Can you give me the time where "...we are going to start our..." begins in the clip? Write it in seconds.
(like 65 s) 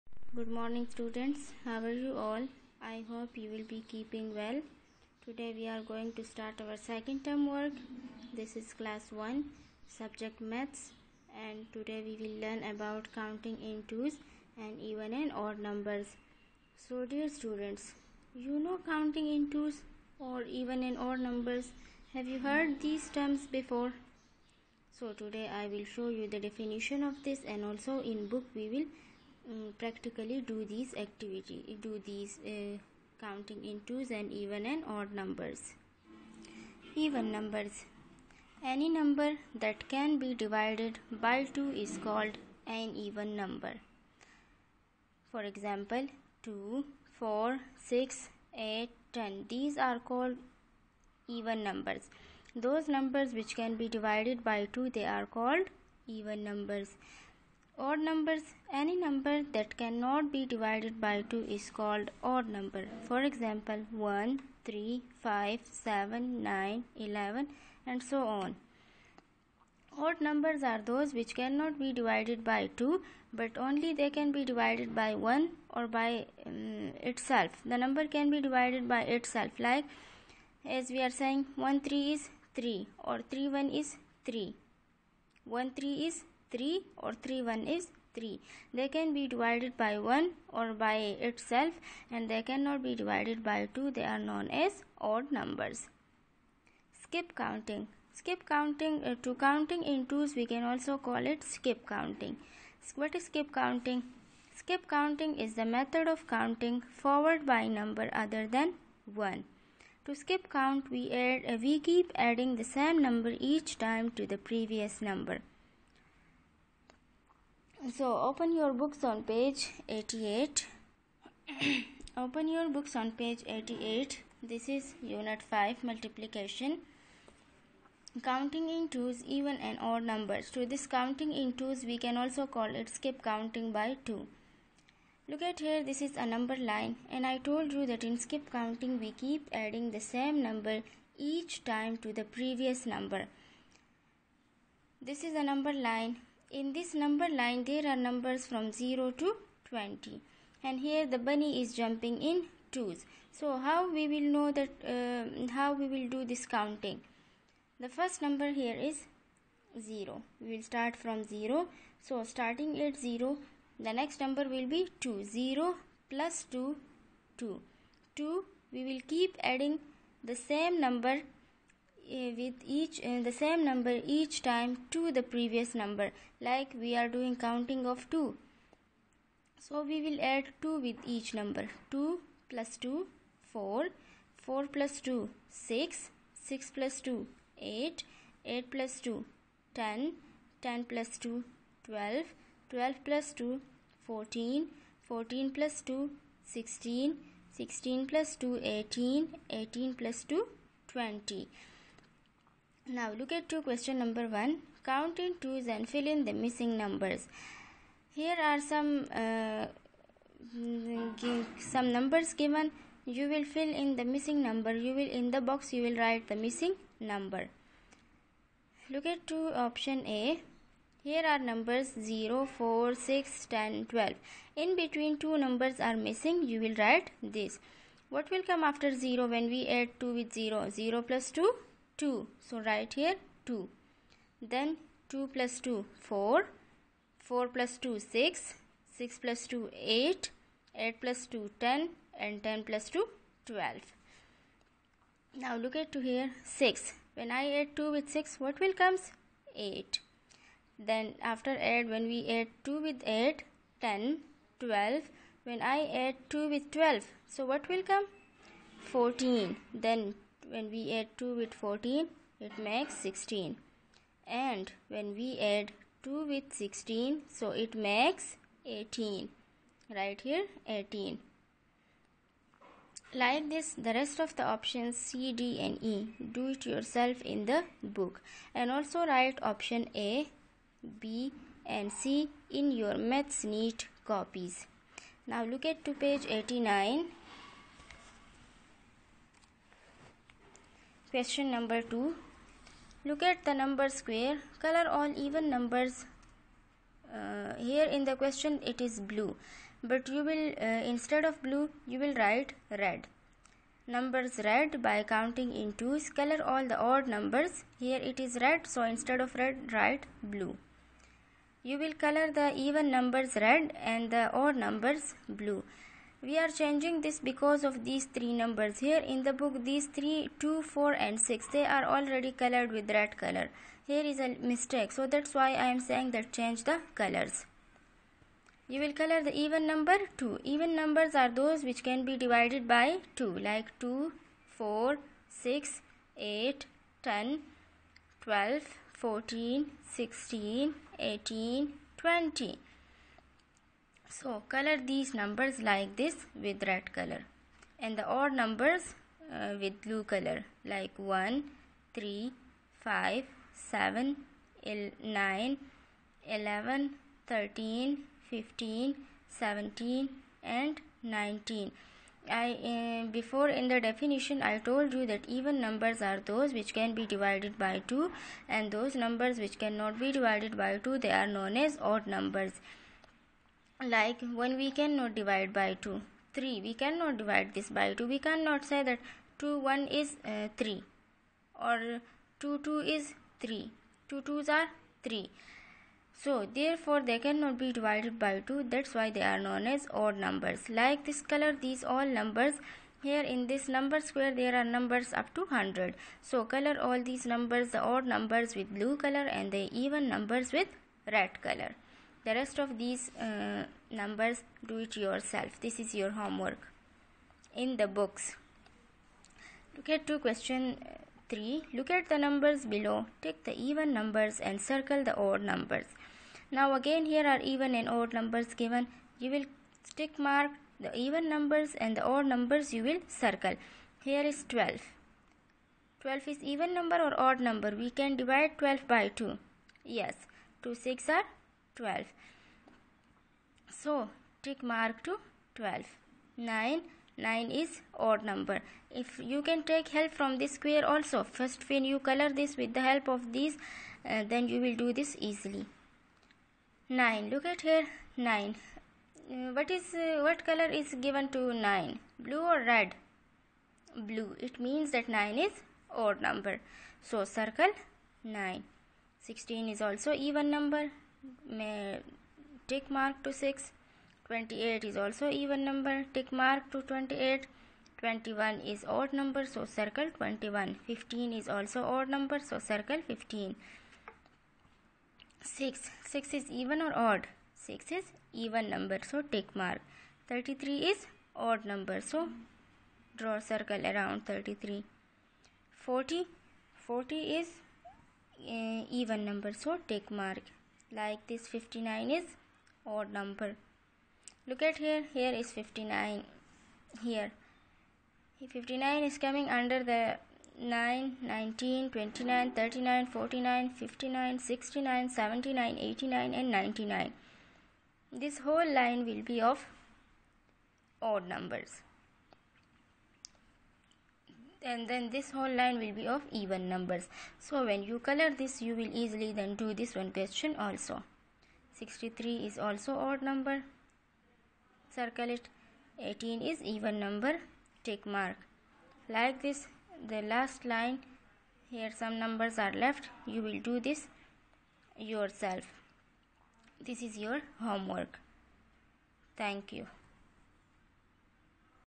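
5 s.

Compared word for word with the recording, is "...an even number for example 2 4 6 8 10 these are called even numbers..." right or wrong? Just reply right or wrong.
right.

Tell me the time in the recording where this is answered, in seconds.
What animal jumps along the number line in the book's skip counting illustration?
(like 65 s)
151 s.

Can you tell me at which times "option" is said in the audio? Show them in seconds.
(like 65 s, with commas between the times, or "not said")
219 s, 274 s, 279 s.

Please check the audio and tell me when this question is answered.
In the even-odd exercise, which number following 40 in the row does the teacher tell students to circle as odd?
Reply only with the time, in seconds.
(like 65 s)
521 s.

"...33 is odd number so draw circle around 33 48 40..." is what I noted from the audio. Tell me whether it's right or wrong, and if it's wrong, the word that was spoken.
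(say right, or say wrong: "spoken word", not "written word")
wrong: "40", not "48".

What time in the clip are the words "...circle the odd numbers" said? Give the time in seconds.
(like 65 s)
414 s.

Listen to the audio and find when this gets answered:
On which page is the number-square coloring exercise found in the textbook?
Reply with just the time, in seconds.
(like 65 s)
285 s.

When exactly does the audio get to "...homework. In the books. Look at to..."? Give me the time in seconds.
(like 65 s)
406 s.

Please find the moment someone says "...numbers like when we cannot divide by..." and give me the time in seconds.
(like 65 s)
372 s.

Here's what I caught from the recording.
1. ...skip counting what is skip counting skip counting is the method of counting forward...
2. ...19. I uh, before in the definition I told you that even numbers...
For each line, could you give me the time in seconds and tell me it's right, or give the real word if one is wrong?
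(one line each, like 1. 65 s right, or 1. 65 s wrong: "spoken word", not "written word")
1. 101 s right
2. 361 s right.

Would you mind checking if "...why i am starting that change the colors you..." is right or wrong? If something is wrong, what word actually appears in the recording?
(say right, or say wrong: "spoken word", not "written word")
wrong: "saying", not "starting".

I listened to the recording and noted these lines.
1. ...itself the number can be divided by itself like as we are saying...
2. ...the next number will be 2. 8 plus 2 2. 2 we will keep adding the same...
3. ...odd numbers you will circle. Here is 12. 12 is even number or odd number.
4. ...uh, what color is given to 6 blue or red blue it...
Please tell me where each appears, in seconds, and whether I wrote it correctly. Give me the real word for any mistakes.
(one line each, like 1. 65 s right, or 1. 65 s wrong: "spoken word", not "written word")
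1. 77 s right
2. 163 s wrong: "0", not "8"
3. 422 s right
4. 449 s wrong: "9", not "6".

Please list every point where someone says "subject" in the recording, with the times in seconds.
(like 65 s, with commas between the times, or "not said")
9 s.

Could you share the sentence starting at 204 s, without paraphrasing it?
Count in twos and fill in the missing numbers.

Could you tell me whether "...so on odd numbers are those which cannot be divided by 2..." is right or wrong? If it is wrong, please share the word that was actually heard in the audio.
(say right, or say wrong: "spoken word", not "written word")
right.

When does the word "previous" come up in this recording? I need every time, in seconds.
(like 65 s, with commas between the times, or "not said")
114 s, 142 s, 175 s.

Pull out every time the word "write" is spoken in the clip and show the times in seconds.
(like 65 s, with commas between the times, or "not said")
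215 s, 226 s, 232 s, 279 s, 302 s, 309 s.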